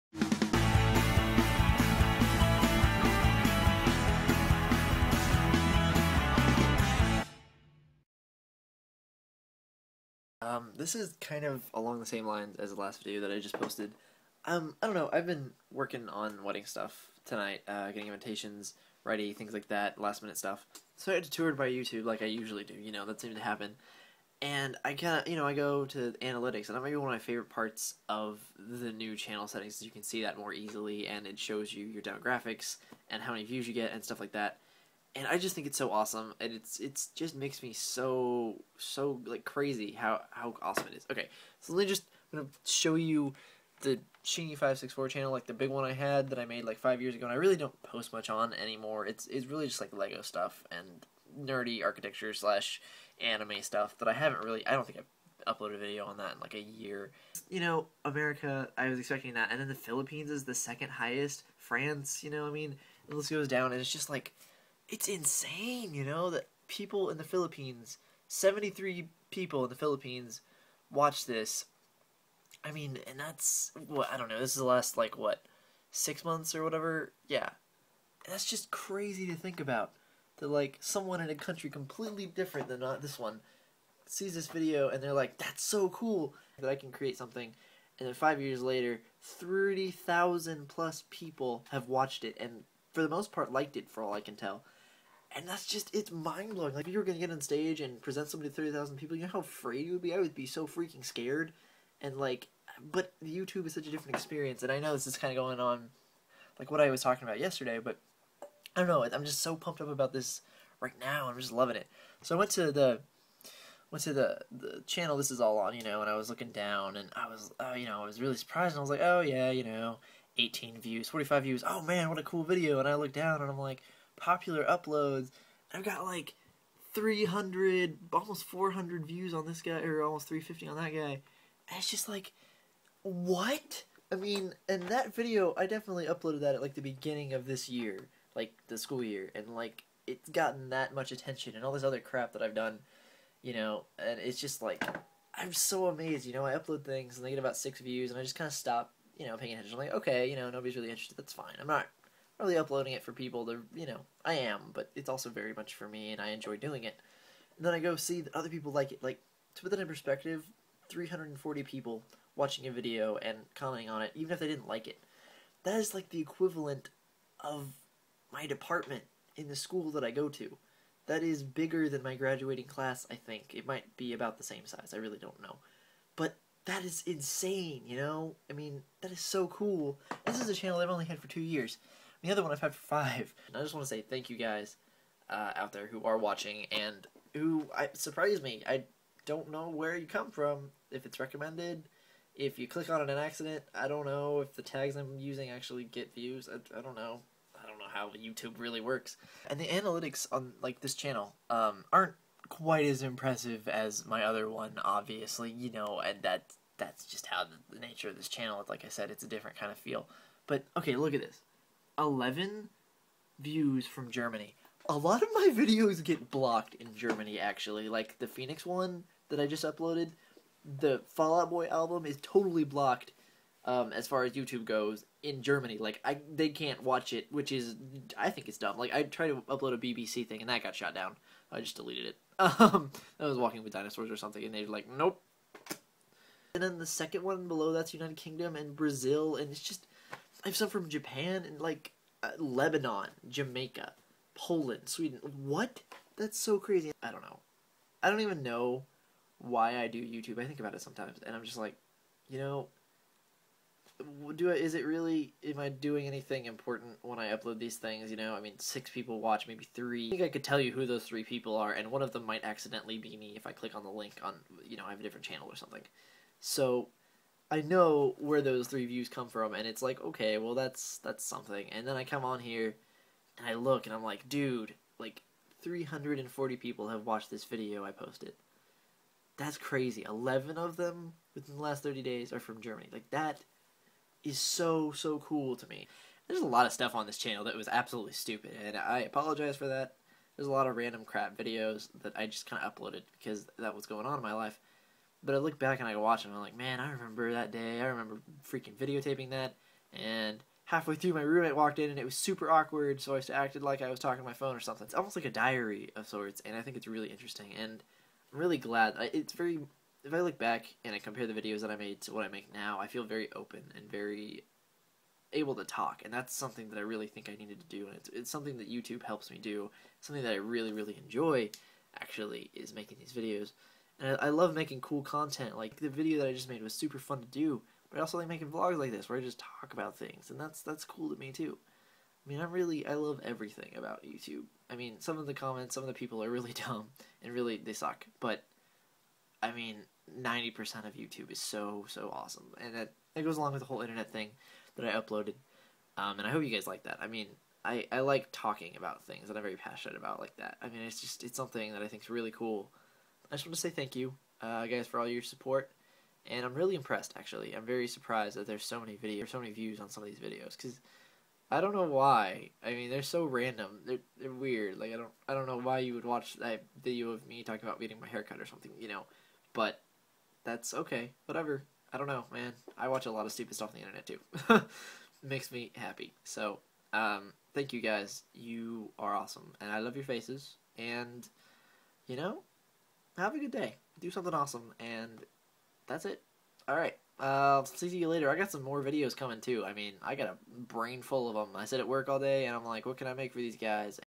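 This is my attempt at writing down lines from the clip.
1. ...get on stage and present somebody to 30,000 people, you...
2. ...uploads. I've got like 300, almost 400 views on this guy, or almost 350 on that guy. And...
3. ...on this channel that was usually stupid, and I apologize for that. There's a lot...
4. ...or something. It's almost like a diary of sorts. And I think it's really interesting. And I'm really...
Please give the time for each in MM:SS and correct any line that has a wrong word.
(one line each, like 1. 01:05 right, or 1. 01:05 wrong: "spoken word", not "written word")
1. 01:37 right
2. 02:04 right
3. 04:46 wrong: "absolutely", not "usually"
4. 05:04 right.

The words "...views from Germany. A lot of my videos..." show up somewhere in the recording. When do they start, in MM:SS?
03:33.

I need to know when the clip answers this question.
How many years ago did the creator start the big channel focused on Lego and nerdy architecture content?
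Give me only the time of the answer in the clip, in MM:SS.
00:46.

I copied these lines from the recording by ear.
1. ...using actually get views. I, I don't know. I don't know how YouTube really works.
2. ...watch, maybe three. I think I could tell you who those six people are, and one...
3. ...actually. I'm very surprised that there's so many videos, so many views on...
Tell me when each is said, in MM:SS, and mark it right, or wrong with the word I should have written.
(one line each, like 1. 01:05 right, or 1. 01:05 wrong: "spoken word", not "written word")
1. 03:15 right
2. 04:19 wrong: "three", not "six"
3. 05:57 right.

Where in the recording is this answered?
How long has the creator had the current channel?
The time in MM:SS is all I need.
03:01.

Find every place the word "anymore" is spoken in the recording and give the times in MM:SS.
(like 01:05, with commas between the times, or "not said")
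00:48.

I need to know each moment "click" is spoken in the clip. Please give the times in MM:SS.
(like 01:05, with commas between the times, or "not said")
03:12, 04:23.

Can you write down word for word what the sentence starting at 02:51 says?
That is bigger than my graduating class, I think.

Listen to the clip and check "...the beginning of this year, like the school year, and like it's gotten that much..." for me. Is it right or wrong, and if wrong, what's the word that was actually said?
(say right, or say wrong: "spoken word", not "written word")
right.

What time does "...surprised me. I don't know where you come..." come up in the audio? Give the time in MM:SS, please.
03:07.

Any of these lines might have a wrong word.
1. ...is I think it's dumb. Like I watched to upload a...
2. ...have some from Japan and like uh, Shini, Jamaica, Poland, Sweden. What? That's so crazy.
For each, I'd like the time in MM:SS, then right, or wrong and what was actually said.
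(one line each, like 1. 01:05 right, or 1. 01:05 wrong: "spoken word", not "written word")
1. 03:47 wrong: "tried", not "watched"
2. 04:00 wrong: "Lebanon", not "Shini".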